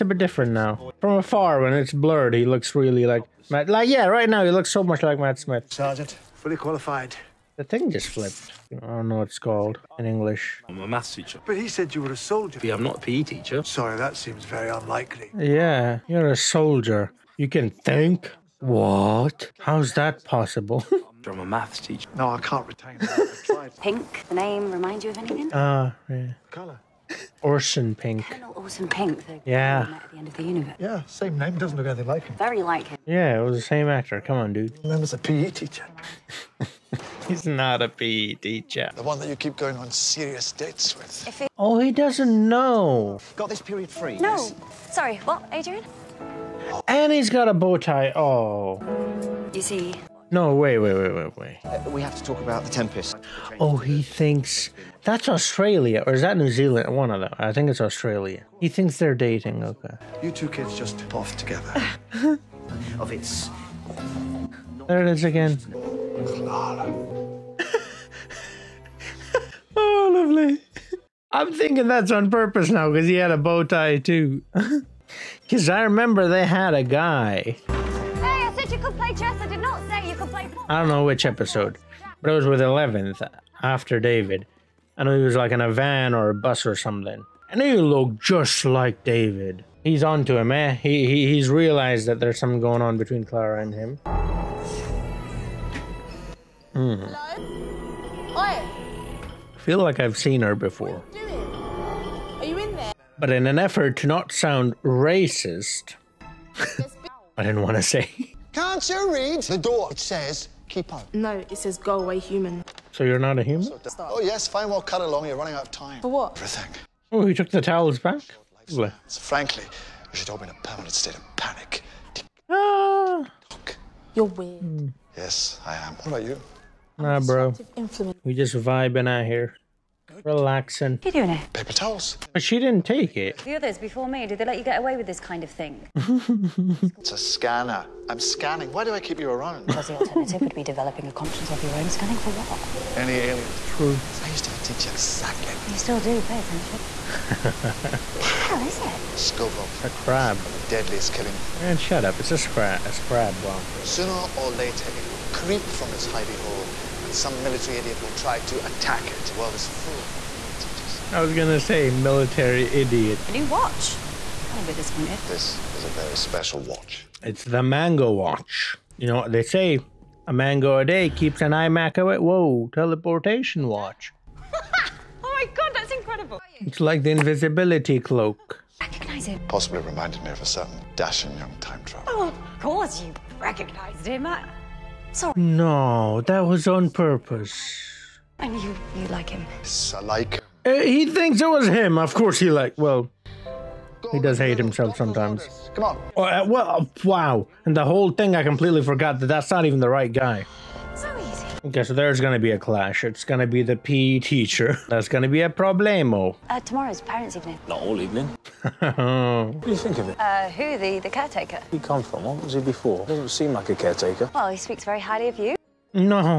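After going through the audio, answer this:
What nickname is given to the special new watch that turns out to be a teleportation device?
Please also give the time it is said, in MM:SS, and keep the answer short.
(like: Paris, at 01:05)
mango watch, at 02:47.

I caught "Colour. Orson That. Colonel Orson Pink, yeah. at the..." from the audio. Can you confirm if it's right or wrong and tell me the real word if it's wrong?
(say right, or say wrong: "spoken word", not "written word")
wrong: "Pink", not "That".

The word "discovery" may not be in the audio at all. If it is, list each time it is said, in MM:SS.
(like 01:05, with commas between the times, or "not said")
not said.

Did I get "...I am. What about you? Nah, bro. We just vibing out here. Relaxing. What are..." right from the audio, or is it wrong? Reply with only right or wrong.
right.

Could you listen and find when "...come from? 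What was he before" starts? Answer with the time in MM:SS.
03:31.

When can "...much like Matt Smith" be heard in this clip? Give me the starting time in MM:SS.
00:04.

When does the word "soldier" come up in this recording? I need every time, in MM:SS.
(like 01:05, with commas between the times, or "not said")
00:12, 00:16.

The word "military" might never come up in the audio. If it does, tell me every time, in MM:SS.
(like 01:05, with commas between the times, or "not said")
02:37, 02:41.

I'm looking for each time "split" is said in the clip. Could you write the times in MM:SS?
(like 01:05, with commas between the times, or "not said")
not said.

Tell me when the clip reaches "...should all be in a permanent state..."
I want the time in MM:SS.
02:00.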